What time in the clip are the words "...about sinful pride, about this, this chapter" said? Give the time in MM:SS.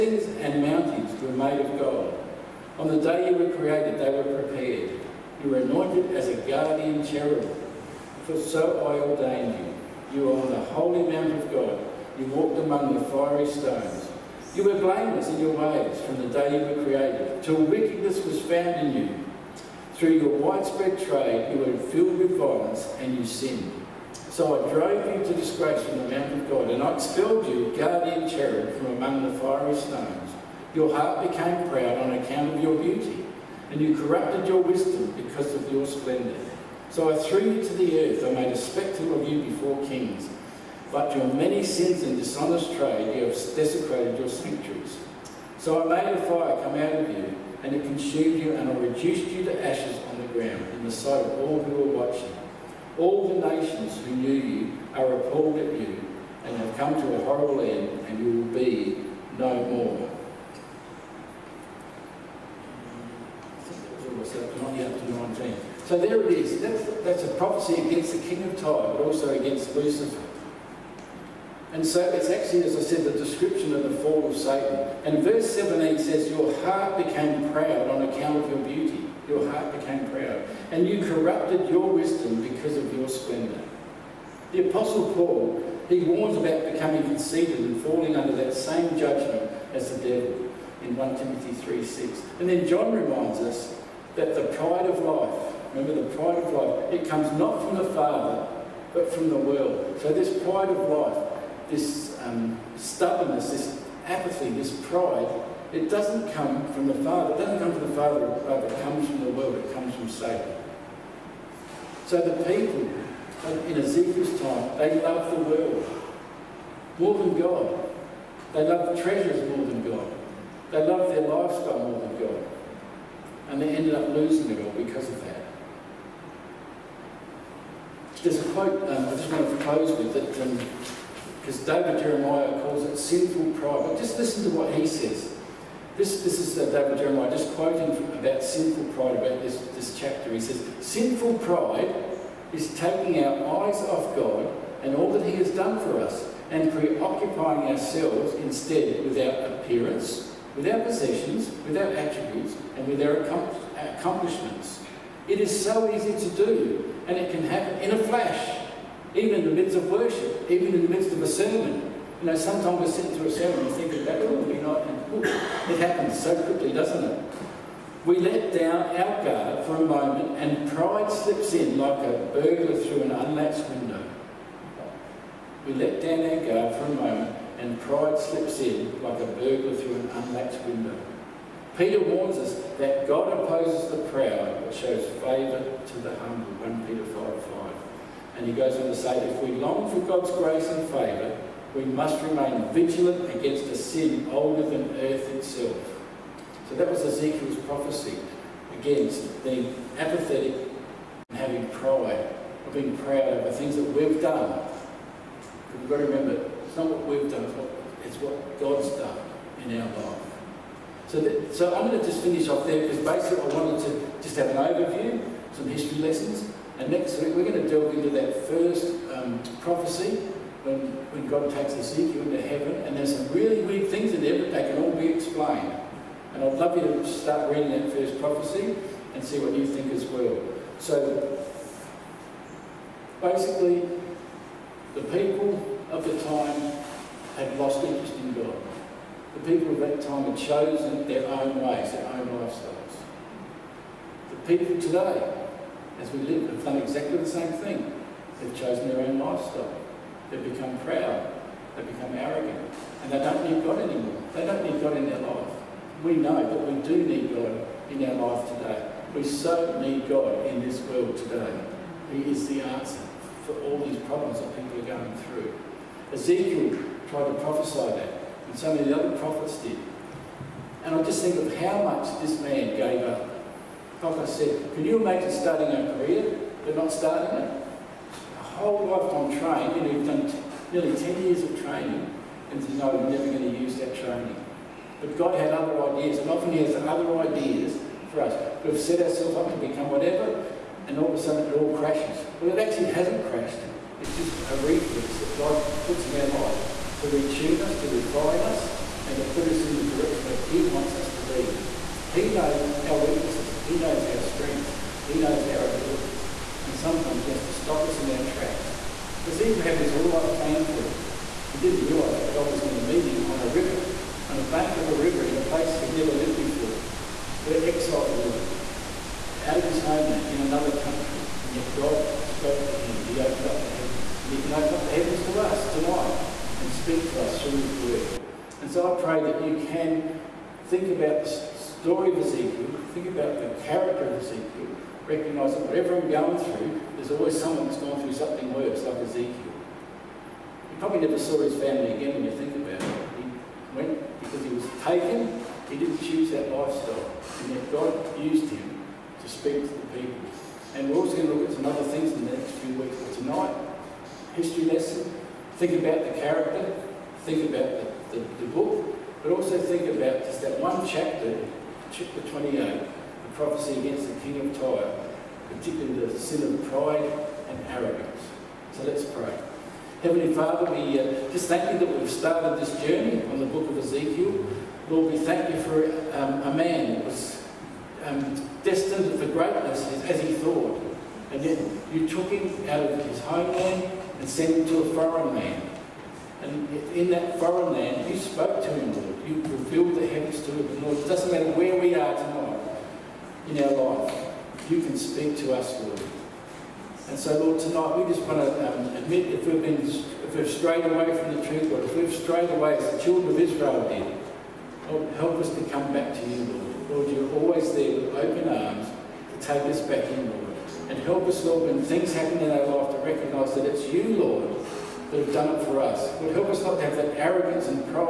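02:18.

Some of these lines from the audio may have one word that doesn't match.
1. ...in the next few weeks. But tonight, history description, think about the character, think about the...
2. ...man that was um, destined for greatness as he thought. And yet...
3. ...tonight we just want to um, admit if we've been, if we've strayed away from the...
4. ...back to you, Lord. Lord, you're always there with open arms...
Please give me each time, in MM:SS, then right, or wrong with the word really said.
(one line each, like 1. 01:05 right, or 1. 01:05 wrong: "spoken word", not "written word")
1. 05:52 wrong: "lesson", not "description"
2. 06:16 right
3. 06:37 right
4. 06:45 right.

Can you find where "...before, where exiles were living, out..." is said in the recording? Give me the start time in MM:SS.
05:16.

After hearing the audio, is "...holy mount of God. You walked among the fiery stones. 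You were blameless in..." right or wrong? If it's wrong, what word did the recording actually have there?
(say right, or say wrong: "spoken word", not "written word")
right.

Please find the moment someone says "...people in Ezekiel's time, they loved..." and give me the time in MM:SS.
01:52.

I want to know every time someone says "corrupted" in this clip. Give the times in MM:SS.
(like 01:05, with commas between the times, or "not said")
00:33, 01:21.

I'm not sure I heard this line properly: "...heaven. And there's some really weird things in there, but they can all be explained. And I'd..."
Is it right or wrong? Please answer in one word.
right.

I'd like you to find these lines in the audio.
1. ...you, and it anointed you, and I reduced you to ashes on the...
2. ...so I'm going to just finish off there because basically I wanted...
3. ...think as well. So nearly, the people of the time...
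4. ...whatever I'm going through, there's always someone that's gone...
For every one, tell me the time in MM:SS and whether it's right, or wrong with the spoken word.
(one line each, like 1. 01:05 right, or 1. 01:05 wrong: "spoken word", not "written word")
1. 00:47 wrong: "consumed", not "anointed"
2. 03:31 right
3. 03:49 wrong: "basically", not "nearly"
4. 05:35 right.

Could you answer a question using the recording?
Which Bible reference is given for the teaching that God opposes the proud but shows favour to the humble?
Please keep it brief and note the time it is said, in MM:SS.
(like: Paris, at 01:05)
1 Peter 5:5, at 03:06.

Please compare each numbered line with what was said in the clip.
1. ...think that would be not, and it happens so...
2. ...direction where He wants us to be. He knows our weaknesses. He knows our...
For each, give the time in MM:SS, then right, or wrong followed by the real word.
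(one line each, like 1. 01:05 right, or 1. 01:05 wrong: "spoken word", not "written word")
1. 02:43 right
2. 04:59 right.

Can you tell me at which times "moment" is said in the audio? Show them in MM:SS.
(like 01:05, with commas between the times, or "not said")
02:49, 02:56.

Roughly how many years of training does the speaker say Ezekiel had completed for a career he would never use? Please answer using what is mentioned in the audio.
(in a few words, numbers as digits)
10 years.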